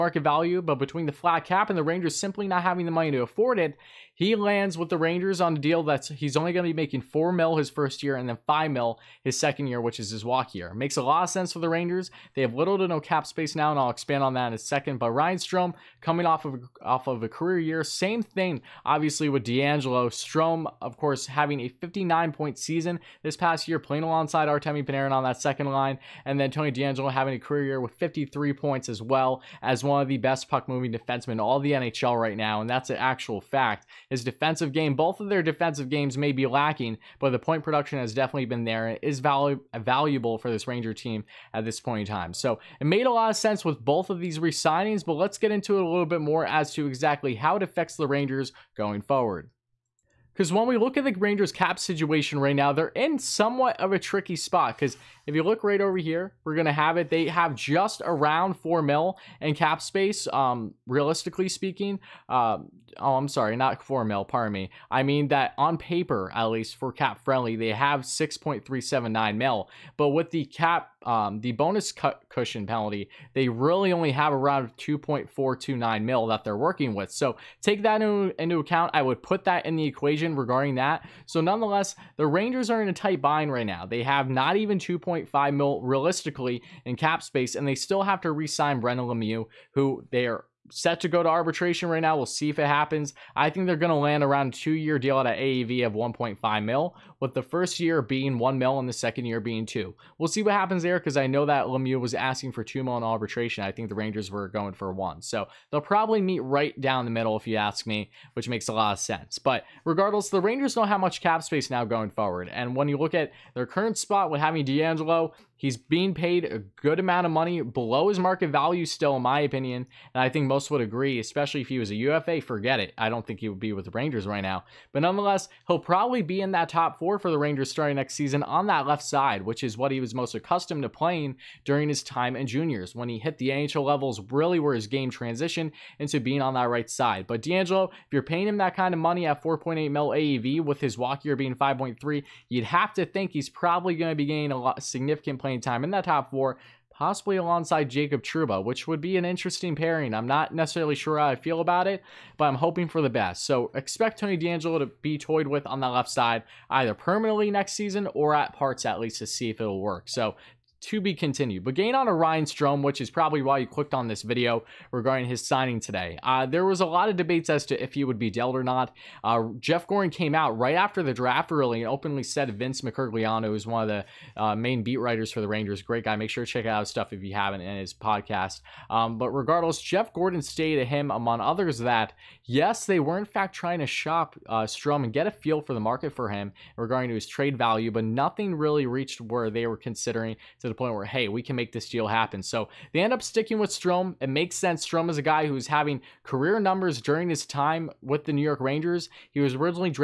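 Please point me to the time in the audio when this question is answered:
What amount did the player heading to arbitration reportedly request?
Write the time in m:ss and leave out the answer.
1:42.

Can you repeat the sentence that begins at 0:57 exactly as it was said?
They have just around 4 mil in cap space, um, realistically speaking.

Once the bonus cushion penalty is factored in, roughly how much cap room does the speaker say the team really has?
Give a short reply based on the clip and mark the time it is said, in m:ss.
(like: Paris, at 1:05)
2.429 mil, at 1:14.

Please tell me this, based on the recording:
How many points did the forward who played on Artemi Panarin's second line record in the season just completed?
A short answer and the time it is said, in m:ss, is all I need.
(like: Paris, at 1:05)
59, at 0:21.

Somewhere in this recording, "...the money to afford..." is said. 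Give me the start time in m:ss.
0:02.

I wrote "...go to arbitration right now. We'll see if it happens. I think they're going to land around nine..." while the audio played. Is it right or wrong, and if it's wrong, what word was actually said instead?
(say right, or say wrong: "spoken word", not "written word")
wrong: "two", not "nine".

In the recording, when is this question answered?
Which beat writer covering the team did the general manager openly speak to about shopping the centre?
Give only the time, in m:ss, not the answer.
2:52.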